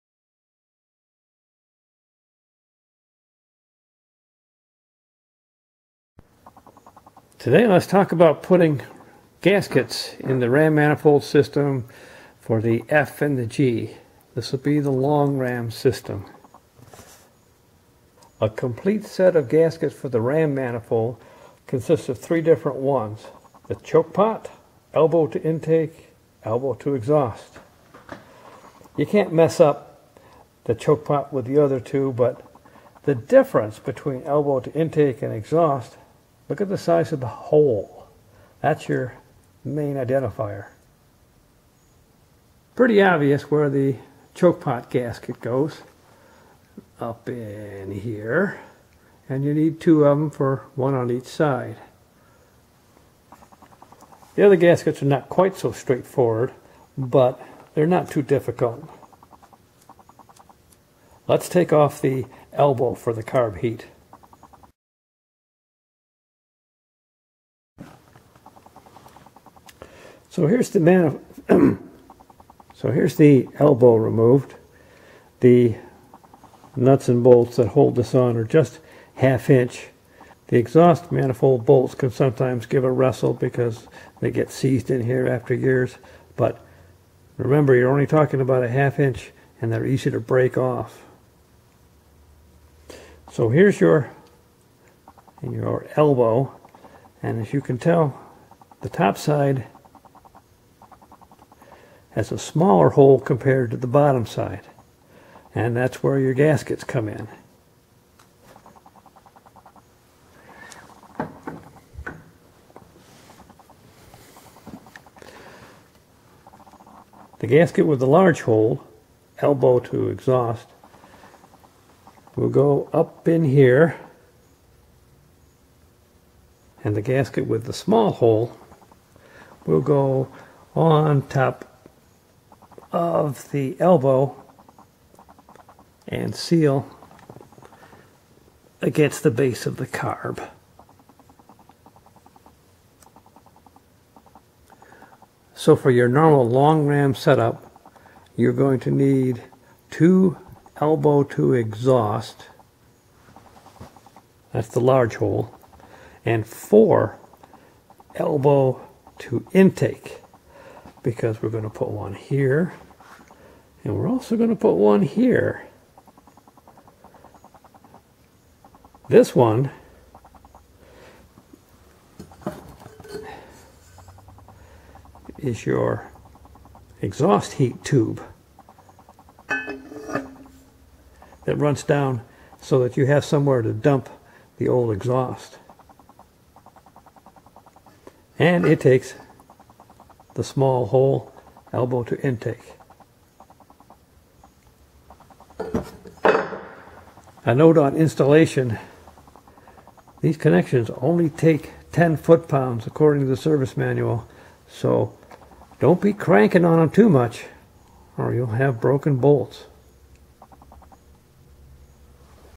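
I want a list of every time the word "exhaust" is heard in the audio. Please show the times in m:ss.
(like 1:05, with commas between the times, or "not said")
0:26, 0:35, 1:20, 2:00, 2:31, 2:57, 3:04.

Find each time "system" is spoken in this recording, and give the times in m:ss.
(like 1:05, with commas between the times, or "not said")
0:11, 0:15.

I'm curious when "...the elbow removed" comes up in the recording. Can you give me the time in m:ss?
1:13.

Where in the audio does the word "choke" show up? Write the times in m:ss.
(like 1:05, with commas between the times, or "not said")
0:23, 0:30, 0:44.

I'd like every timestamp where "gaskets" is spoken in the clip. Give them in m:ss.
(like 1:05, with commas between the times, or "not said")
0:09, 0:19, 0:44, 0:54, 1:46, 1:57, 2:07.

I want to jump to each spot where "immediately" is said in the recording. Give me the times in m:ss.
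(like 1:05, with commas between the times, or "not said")
not said.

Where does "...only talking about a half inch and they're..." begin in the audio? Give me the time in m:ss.
1:27.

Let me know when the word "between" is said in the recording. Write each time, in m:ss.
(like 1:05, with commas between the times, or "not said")
0:33.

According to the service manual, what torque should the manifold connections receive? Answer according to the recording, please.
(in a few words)
10 foot-pounds.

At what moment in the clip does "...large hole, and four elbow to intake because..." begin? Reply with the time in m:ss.
2:34.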